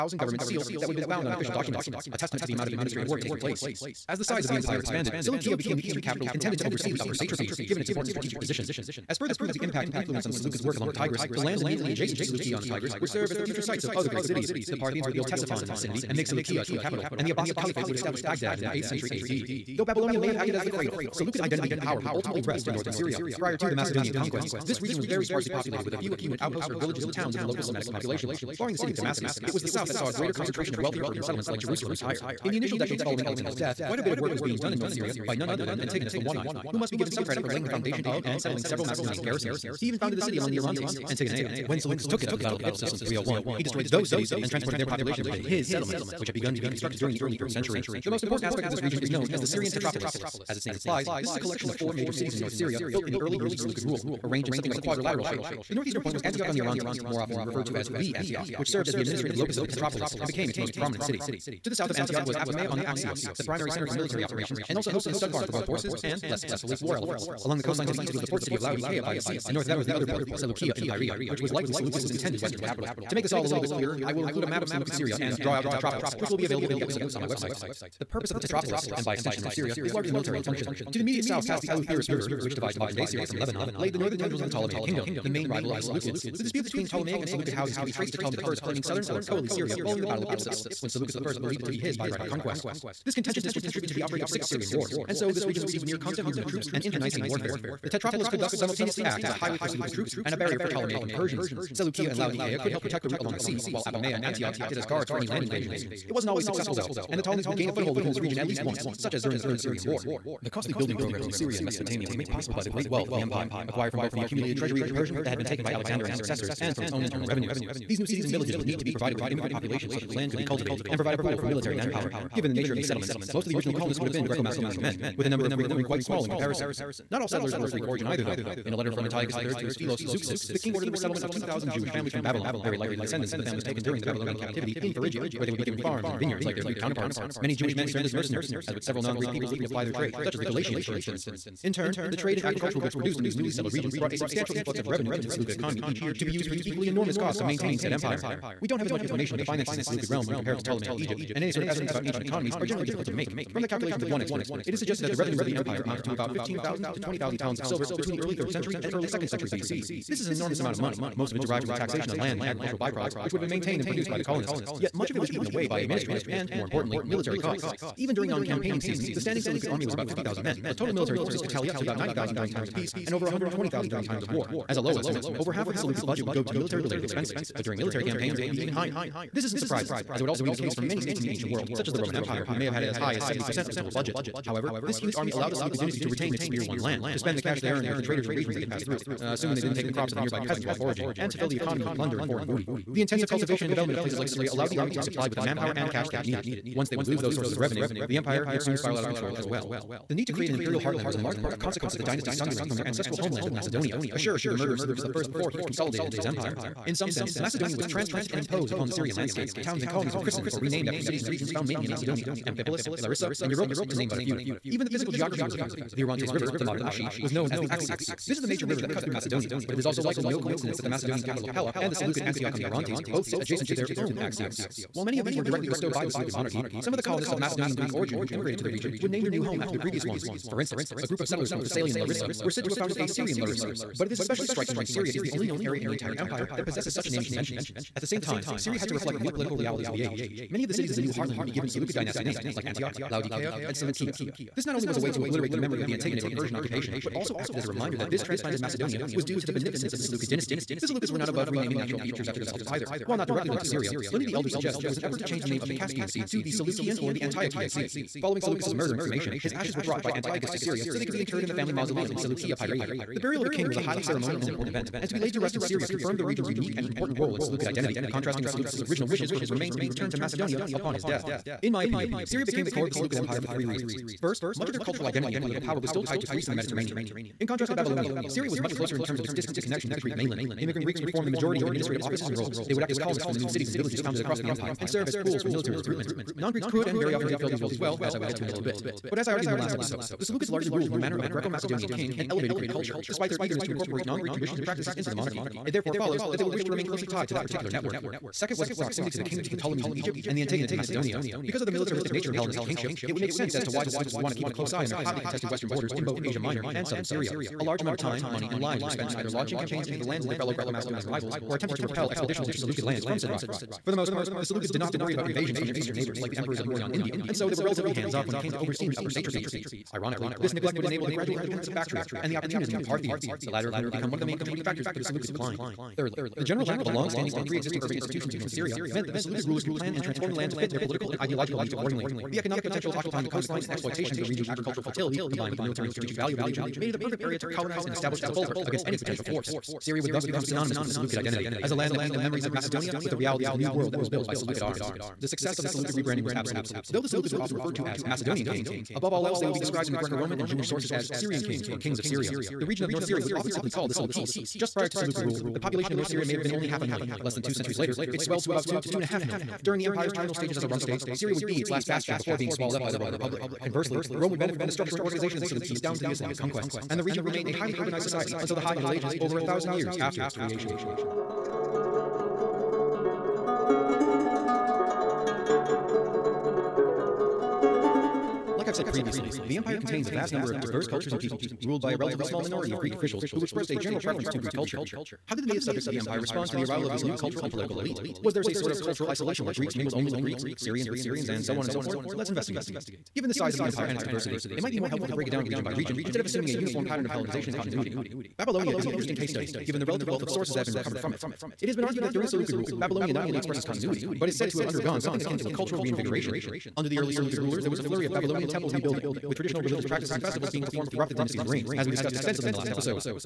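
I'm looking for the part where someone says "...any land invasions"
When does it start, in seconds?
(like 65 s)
105 s.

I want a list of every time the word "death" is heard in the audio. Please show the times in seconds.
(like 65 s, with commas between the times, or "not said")
33 s, 271 s.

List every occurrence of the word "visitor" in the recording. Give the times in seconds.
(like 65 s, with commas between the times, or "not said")
not said.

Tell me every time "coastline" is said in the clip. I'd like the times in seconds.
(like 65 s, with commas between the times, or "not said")
67 s, 333 s.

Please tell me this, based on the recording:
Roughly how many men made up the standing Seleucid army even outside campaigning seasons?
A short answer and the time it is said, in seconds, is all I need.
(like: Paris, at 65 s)
50,000, at 170 s.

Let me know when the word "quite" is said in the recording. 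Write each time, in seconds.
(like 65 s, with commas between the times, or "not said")
33 s, 125 s.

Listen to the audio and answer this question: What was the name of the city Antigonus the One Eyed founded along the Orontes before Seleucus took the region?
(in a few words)
Antigonea.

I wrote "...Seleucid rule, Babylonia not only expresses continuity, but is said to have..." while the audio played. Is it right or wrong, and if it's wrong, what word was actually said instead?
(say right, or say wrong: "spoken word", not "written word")
right.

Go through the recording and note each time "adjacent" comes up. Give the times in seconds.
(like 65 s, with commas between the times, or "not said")
11 s, 223 s.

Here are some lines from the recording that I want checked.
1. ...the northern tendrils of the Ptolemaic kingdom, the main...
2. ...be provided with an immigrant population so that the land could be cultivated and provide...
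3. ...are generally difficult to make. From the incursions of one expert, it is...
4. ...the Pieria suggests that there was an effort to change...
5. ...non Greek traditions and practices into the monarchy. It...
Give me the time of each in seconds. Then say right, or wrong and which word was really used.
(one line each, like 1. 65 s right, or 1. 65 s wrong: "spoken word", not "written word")
1. 83 s right
2. 118 s right
3. 152 s wrong: "calculations", not "incursions"
4. 254 s wrong: "Elder", not "Pieria"
5. 294 s right.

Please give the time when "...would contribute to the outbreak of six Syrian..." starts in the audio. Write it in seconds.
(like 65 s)
93 s.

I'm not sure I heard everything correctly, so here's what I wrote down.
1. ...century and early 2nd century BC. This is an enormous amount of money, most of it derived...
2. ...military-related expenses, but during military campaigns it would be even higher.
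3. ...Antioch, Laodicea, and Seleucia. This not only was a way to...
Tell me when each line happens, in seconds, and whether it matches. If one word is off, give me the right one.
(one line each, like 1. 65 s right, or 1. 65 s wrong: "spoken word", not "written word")
1. 158 s right
2. 176 s right
3. 242 s right.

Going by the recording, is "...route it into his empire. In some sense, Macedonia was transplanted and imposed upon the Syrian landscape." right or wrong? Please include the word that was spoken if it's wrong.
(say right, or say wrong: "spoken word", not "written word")
wrong: "consolidate", not "route".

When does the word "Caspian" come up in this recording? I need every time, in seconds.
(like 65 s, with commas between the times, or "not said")
255 s.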